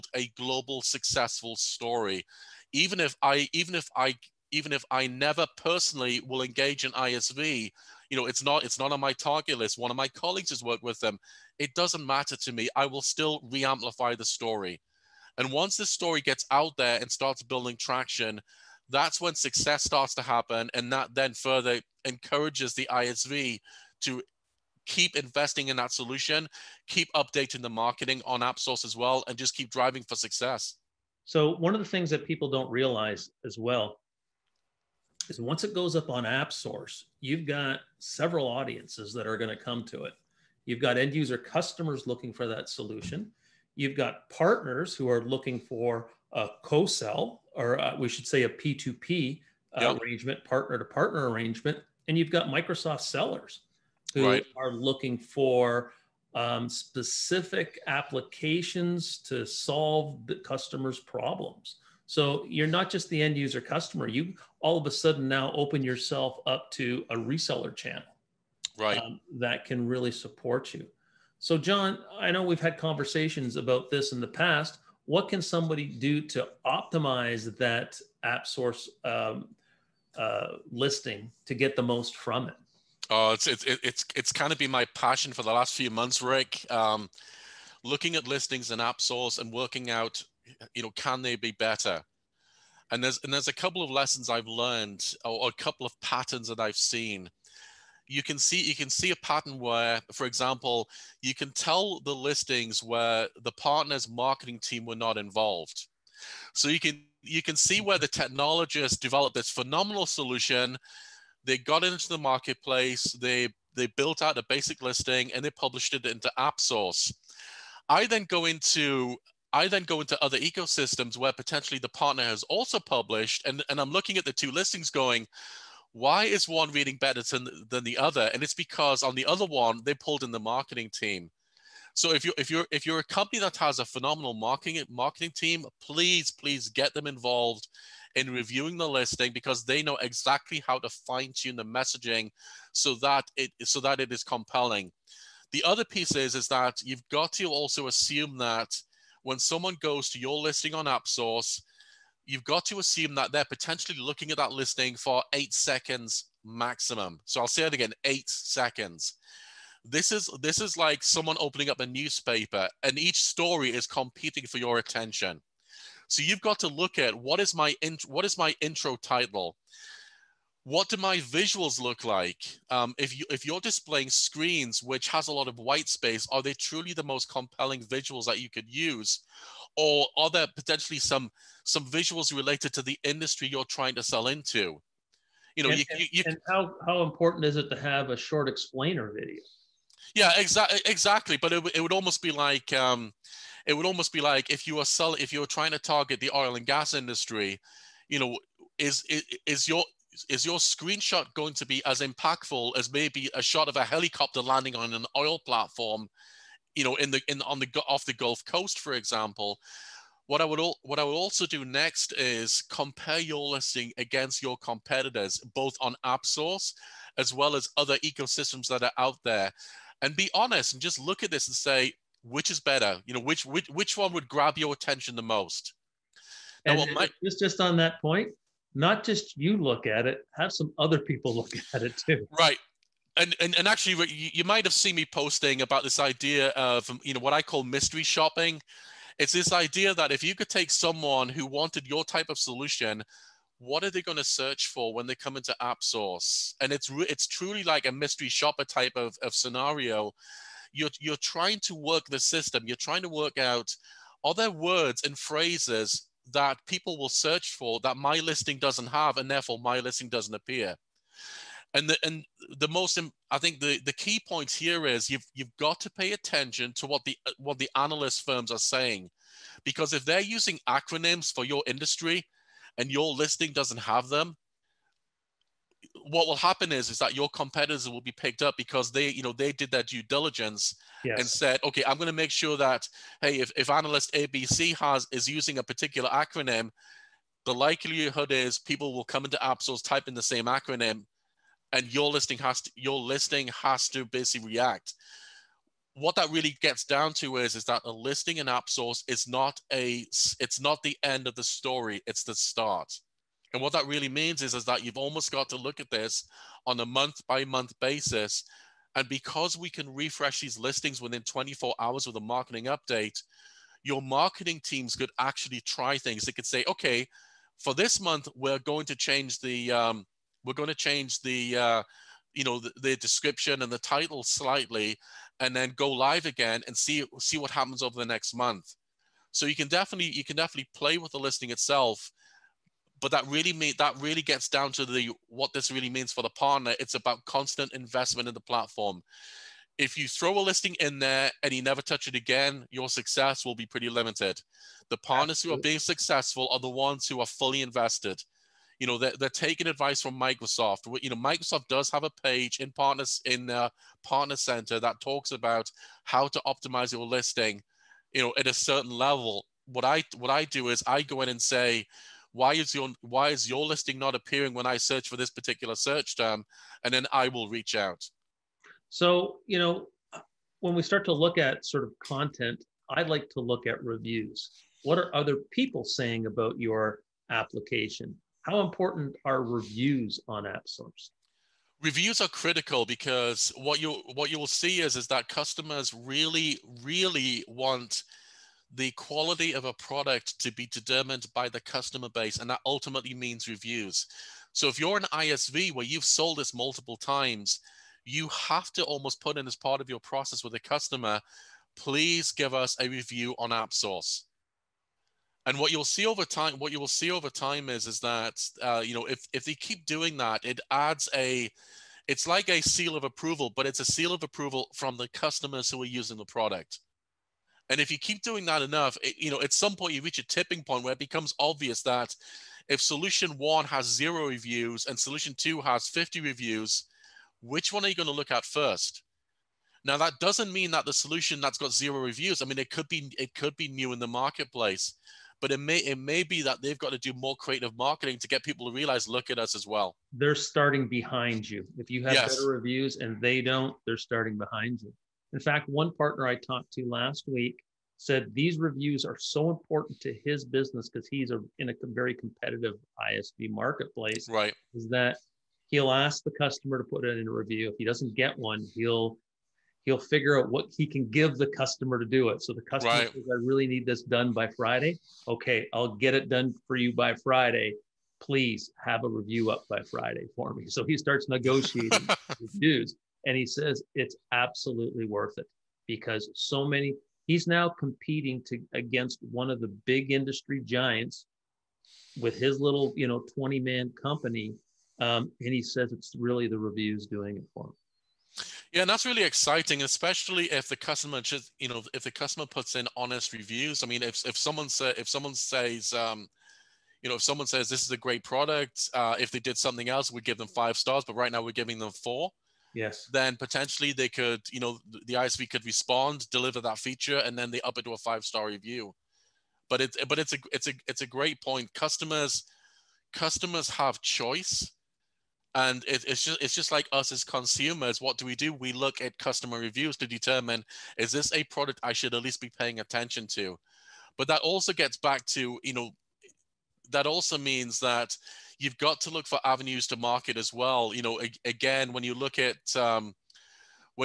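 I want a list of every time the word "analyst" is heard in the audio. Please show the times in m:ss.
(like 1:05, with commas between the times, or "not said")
4:27, 4:43.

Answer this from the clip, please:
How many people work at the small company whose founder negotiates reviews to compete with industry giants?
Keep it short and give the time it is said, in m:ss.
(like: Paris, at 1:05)
20, at 8:03.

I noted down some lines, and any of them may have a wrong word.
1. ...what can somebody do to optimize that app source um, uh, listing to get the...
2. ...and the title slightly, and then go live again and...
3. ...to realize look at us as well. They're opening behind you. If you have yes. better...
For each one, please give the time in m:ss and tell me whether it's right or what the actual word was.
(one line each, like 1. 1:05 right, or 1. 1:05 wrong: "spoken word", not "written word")
1. 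1:15 right
2. 5:23 right
3. 7:18 wrong: "starting", not "opening".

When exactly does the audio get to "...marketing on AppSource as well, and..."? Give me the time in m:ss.
0:27.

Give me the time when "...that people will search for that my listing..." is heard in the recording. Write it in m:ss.
4:16.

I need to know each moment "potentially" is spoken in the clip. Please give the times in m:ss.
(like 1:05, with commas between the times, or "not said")
2:01, 2:33, 3:00, 8:23.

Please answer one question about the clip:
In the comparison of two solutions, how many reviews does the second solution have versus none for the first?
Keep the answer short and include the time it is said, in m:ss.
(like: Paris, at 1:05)
50, at 7:05.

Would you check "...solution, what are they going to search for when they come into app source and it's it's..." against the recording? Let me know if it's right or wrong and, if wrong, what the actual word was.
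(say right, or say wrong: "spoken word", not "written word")
right.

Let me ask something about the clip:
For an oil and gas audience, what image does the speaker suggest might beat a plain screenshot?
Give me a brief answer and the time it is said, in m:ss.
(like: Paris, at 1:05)
A helicopter landing on an oil platform, at 3:23.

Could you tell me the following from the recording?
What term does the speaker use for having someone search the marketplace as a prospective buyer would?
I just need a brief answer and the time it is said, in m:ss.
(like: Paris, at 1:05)
Mystery shopping, at 3:57.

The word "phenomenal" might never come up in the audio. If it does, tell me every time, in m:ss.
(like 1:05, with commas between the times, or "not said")
1:49, 2:13.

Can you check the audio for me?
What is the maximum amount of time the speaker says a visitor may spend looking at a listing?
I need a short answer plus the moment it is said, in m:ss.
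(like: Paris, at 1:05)
8 seconds, at 2:35.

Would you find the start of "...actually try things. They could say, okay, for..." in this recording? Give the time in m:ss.
5:15.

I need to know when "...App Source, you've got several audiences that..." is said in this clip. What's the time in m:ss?
0:36.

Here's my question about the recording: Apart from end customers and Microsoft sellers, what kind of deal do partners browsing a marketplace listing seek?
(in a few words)
Partner to partner.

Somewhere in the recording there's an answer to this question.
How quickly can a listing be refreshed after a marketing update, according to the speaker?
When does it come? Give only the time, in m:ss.
5:11.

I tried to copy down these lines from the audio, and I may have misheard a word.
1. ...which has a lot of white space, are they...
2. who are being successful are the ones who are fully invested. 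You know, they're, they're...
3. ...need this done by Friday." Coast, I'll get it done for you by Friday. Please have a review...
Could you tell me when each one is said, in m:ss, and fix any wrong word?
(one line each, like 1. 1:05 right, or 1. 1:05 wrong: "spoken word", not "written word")
1. 2:54 right
2. 5:45 right
3. 7:43 wrong: "Okay", not "Coast".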